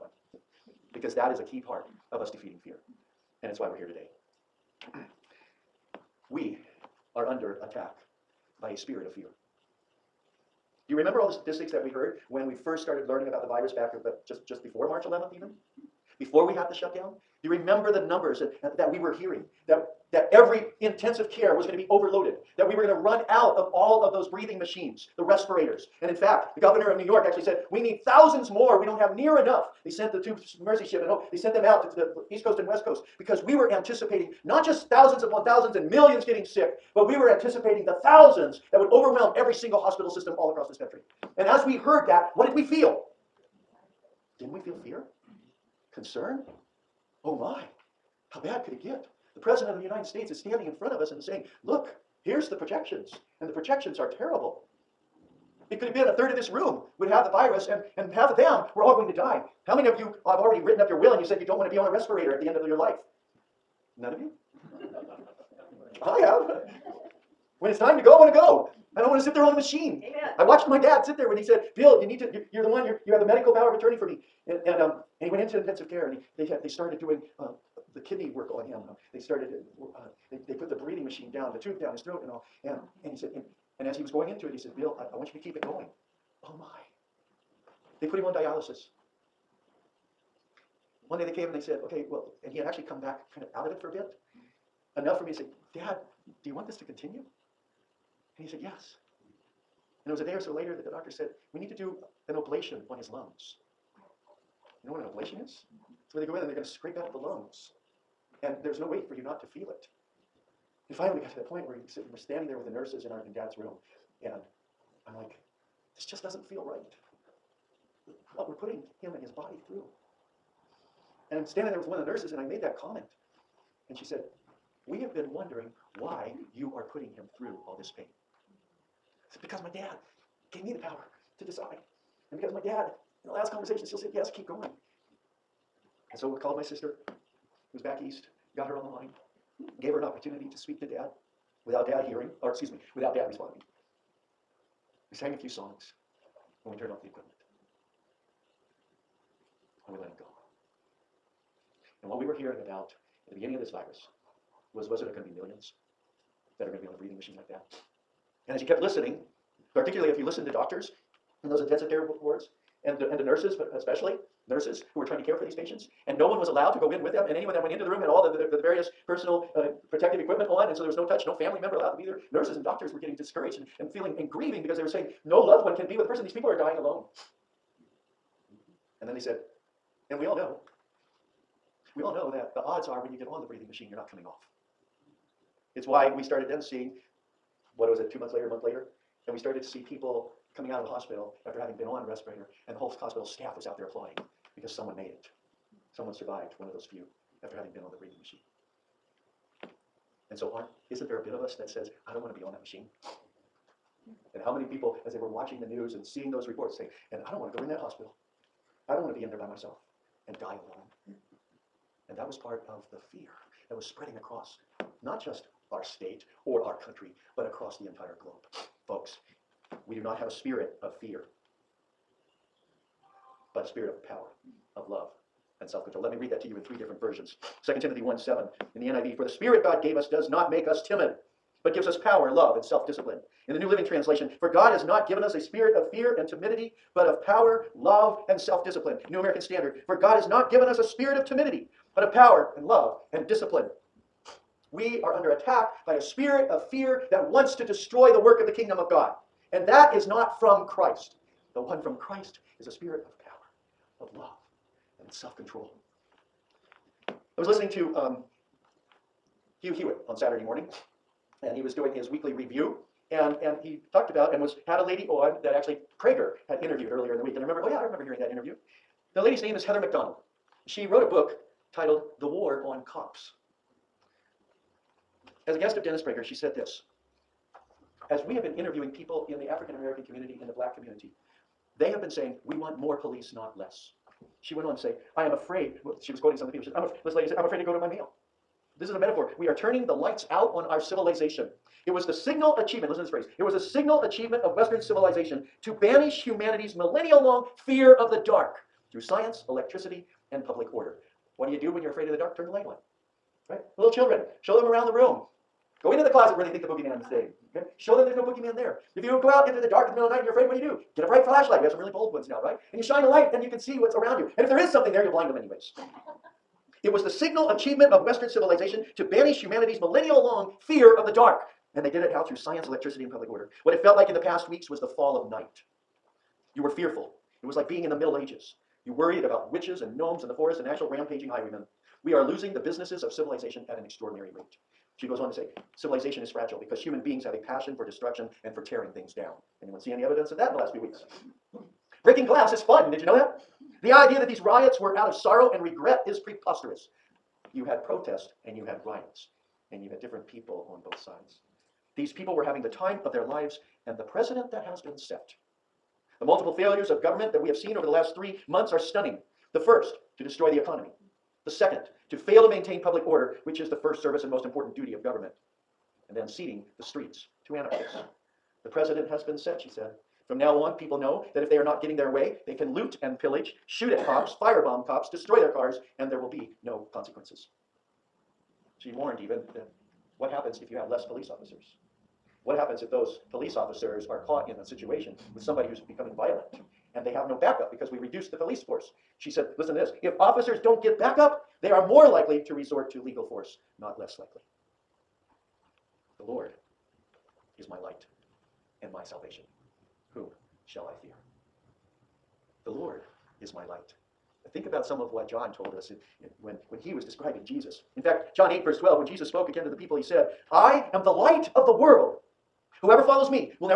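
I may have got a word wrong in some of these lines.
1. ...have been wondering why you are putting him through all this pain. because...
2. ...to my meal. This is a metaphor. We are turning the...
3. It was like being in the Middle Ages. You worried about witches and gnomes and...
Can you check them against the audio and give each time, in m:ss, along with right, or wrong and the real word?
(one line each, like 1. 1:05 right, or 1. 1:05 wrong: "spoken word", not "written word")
1. 2:04 right
2. 4:47 right
3. 5:27 right.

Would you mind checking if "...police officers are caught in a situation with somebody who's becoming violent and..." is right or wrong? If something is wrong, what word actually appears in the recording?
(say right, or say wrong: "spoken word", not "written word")
right.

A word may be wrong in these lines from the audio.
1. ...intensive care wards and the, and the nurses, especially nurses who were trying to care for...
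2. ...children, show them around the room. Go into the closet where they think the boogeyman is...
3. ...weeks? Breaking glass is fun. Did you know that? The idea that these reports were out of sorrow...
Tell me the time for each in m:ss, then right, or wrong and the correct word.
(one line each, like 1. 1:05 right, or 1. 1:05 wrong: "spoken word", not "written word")
1. 2:41 right
2. 5:03 right
3. 5:40 wrong: "riots", not "reports".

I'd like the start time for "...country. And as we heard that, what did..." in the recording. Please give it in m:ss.
0:40.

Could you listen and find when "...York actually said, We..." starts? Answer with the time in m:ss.
0:27.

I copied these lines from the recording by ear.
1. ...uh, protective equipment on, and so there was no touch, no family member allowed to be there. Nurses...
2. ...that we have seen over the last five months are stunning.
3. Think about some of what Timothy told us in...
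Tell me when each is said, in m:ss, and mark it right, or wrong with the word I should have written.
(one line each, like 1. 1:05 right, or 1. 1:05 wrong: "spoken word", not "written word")
1. 2:49 right
2. 5:57 wrong: "three", not "five"
3. 6:44 wrong: "John", not "Timothy".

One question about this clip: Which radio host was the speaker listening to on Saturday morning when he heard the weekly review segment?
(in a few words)
Hugh Hewitt.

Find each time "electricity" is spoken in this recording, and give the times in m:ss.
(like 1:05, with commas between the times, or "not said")
4:59, 5:22.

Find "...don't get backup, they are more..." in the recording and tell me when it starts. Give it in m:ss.
6:30.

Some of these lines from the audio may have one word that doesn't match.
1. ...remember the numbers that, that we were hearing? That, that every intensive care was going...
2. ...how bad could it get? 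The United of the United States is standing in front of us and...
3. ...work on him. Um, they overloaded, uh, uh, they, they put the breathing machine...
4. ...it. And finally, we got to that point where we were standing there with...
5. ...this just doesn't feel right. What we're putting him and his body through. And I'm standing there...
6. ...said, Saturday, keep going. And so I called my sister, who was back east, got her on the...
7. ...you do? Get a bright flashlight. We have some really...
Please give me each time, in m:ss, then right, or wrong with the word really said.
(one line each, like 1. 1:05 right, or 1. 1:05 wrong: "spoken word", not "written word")
1. 0:17 right
2. 0:48 wrong: "President", not "United"
3. 1:18 wrong: "started", not "overloaded"
4. 1:49 right
5. 1:55 right
6. 2:13 wrong: "Yes", not "Saturday"
7. 5:10 right.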